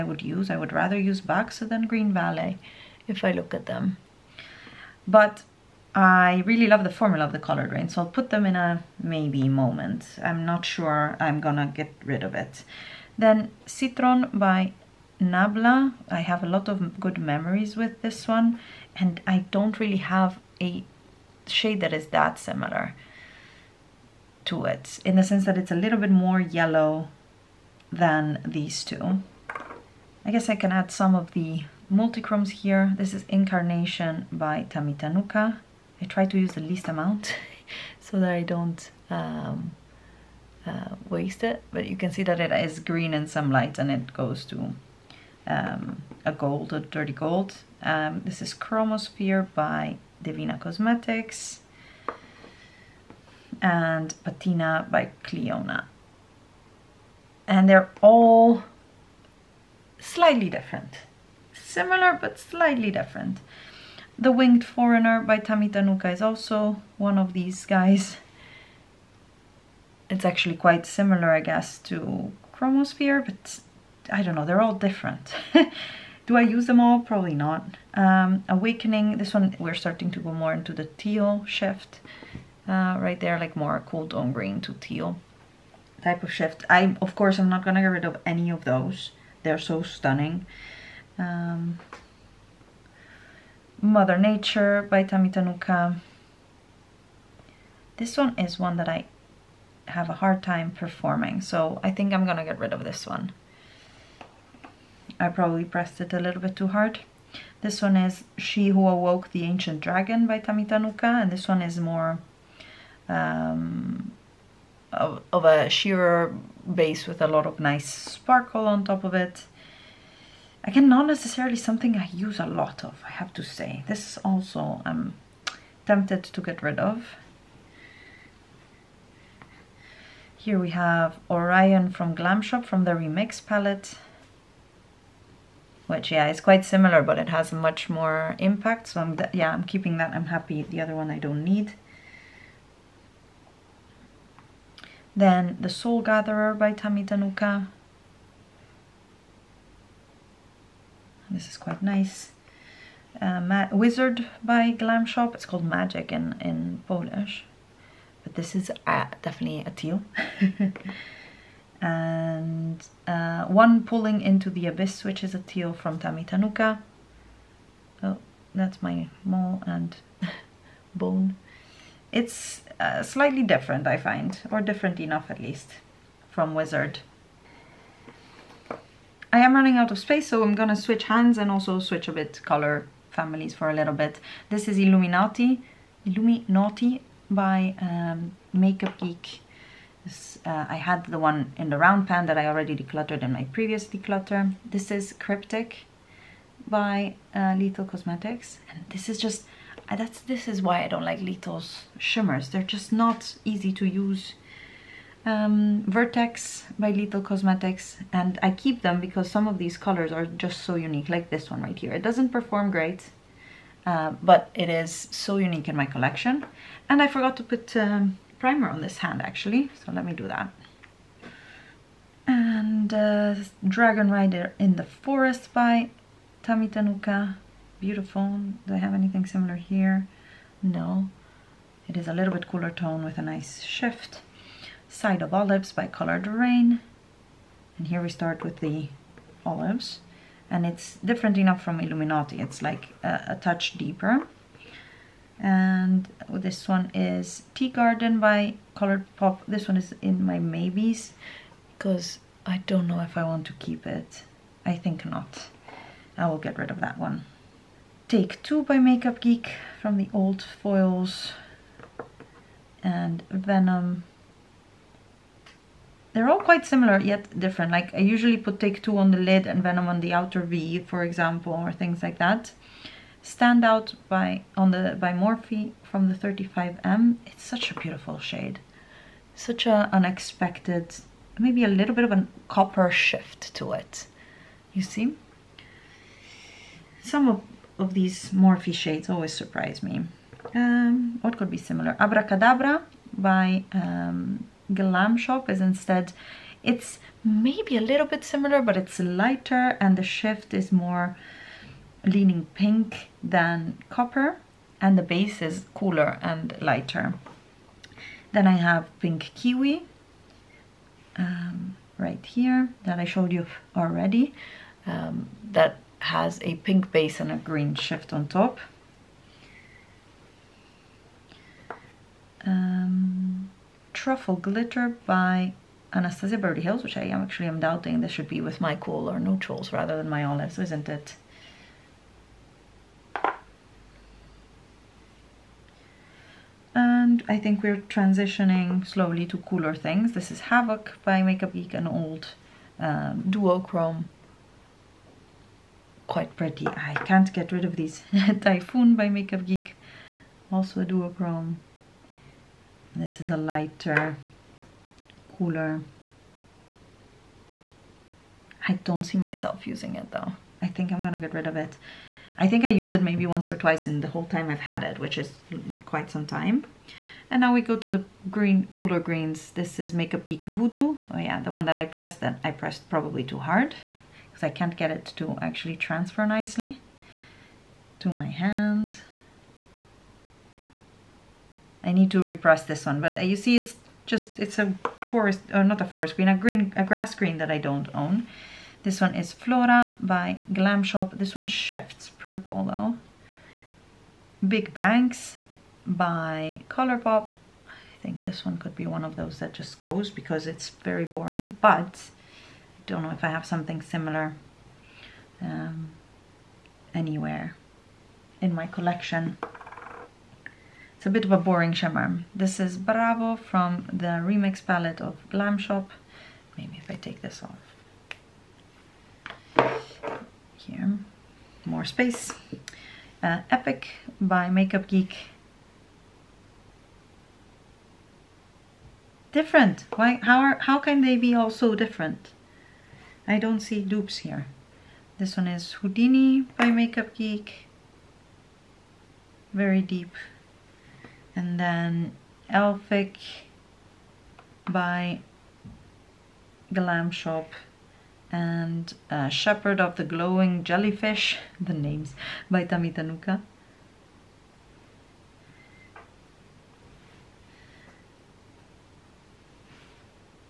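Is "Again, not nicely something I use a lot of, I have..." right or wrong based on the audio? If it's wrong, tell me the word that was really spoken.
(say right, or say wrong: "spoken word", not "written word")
wrong: "necessarily", not "nicely".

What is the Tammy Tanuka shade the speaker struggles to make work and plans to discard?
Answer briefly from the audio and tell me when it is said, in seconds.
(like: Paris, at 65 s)
Mother Nature, at 93 s.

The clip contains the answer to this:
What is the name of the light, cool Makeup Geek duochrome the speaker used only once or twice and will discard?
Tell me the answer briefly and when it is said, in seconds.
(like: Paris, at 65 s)
Typhoon, at 348 s.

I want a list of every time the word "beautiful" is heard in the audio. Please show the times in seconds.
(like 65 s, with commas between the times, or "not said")
227 s, 277 s.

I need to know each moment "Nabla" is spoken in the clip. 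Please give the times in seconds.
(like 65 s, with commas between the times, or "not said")
15 s.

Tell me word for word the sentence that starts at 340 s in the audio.
This is Havoc by Makeup Geek, an old um, duochrome.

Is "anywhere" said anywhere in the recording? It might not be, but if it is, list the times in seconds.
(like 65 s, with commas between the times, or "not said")
406 s.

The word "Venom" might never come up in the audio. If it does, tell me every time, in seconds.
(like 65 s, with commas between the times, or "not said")
263 s, 269 s.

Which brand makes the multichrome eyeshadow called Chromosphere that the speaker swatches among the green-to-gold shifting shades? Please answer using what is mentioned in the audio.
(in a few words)
Devinah Cosmetics.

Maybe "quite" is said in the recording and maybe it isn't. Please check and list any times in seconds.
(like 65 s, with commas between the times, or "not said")
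70 s, 136 s, 151 s, 266 s, 346 s, 365 s.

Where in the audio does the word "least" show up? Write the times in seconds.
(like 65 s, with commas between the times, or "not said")
36 s, 175 s.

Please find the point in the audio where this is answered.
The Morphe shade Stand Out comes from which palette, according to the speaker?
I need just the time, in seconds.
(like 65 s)
276 s.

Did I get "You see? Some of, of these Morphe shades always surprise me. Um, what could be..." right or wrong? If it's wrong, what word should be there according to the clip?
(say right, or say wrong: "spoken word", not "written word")
right.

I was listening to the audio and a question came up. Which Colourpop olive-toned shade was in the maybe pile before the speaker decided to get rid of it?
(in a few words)
Tea Garden.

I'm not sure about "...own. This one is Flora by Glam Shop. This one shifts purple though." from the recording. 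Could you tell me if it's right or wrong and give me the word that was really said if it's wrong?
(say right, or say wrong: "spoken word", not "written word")
right.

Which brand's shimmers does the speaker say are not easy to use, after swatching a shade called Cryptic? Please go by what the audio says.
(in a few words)
Lethal Cosmetics.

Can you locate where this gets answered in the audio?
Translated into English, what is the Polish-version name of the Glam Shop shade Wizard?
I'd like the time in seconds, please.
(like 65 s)
155 s.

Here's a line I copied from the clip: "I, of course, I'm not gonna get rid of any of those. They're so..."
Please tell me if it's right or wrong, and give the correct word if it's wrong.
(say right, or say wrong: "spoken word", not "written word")
right.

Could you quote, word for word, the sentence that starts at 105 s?
I probably pressed it a little bit too hard.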